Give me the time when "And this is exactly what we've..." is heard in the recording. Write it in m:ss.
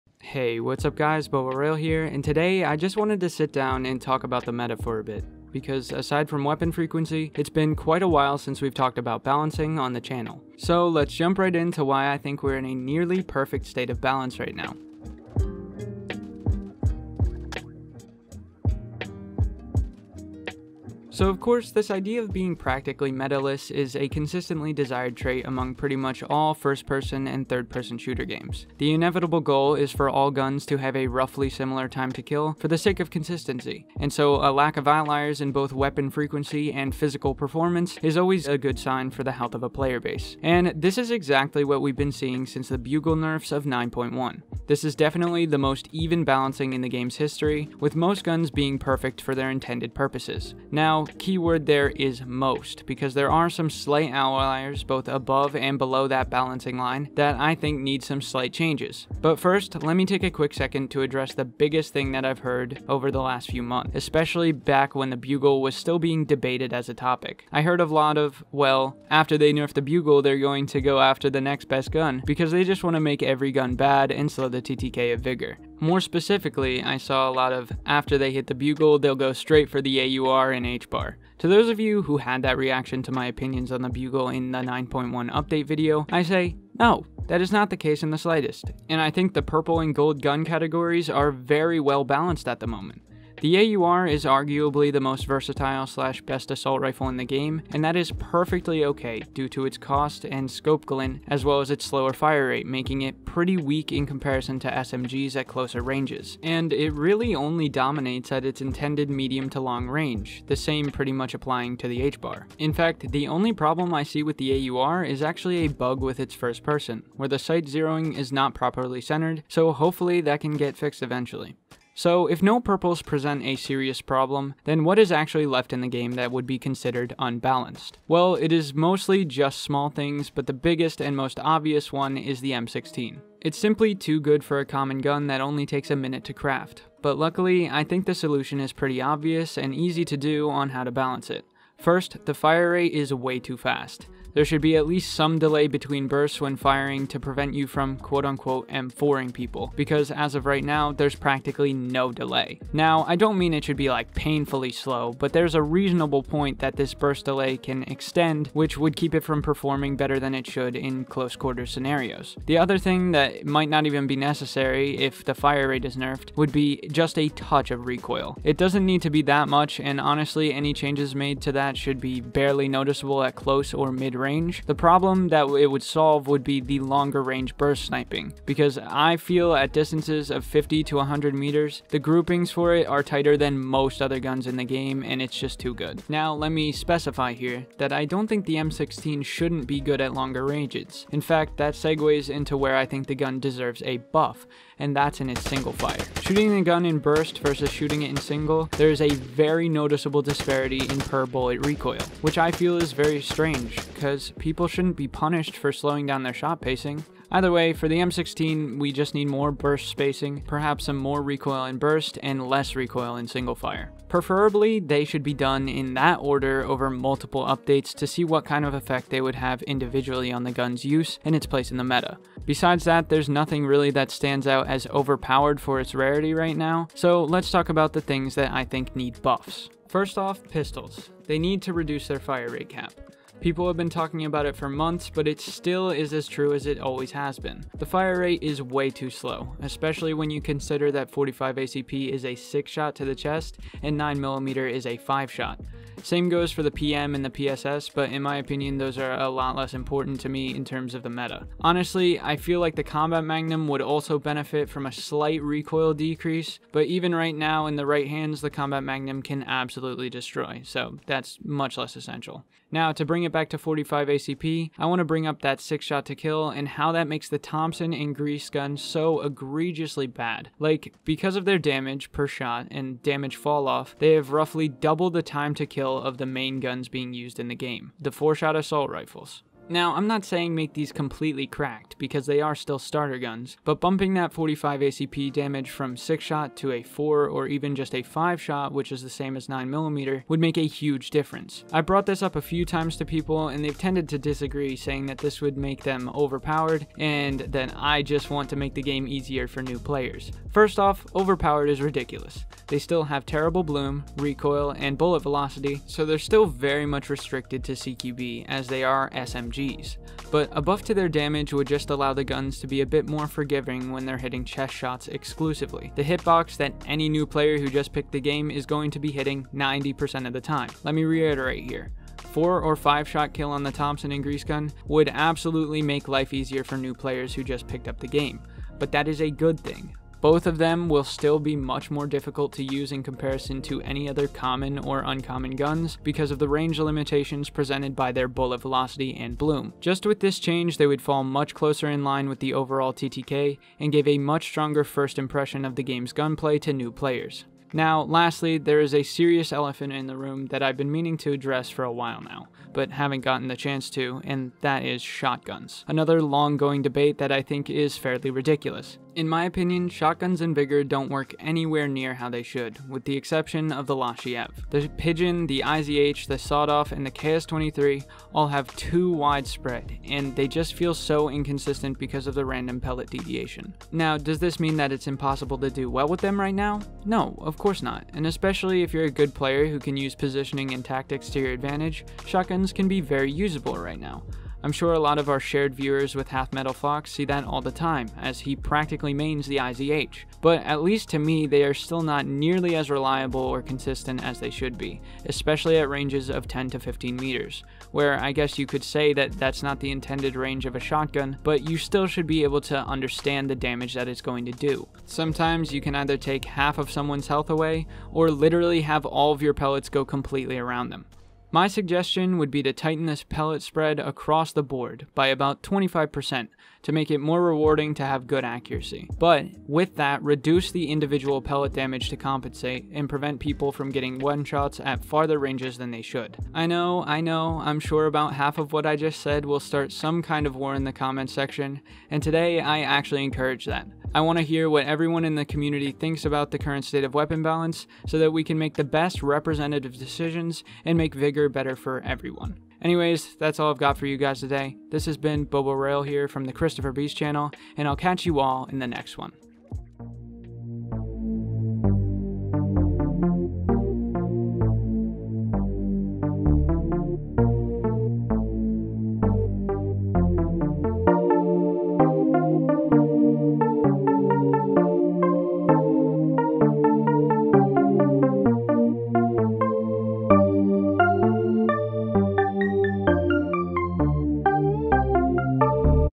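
0:40.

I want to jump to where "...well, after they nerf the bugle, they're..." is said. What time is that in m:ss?
1:08.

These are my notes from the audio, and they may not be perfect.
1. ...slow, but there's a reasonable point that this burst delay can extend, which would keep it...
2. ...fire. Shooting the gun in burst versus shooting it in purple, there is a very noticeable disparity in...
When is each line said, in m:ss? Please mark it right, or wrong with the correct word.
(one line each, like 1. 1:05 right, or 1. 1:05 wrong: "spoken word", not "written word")
1. 2:34 right
2. 3:15 wrong: "single", not "purple".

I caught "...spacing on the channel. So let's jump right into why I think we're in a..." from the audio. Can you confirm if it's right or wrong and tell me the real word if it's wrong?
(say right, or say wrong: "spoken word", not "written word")
wrong: "balancing", not "spacing".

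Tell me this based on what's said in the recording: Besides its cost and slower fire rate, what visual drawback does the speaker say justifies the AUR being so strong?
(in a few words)
scope glint.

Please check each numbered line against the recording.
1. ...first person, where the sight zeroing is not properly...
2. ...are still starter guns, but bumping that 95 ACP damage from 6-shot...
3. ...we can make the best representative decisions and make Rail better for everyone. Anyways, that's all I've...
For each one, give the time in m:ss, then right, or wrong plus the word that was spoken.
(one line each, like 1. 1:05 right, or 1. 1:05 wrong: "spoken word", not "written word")
1. 1:56 right
2. 4:42 wrong: "45", not "95"
3. 7:18 wrong: "Vigor", not "Rail".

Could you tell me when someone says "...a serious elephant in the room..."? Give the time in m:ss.
5:48.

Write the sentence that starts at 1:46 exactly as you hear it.
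And it really only dominates at its intended medium to long range, the same pretty much applying to the H-bar.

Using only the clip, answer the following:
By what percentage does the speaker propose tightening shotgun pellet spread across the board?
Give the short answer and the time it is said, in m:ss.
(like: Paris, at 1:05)
25%, at 6:55.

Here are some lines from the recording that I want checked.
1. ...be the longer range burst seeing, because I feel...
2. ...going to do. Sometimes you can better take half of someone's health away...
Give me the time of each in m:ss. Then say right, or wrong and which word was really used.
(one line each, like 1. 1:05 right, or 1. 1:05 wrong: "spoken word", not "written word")
1. 2:56 wrong: "sniping", not "seeing"
2. 6:44 wrong: "either", not "better".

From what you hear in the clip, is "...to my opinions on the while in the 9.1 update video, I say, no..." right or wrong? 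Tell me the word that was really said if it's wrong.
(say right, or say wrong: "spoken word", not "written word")
wrong: "bugle", not "while".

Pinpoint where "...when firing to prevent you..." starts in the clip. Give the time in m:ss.
2:26.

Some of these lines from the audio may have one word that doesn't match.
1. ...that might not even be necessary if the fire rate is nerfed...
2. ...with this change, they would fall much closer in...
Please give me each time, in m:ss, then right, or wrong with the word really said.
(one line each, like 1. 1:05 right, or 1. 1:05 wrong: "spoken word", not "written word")
1. 2:43 right
2. 5:40 right.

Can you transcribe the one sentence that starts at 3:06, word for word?
Now, let me specify here that I don't think the M16 shouldn't be good at longer ranges.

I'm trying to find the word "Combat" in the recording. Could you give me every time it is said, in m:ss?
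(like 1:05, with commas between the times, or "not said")
4:12, 4:18.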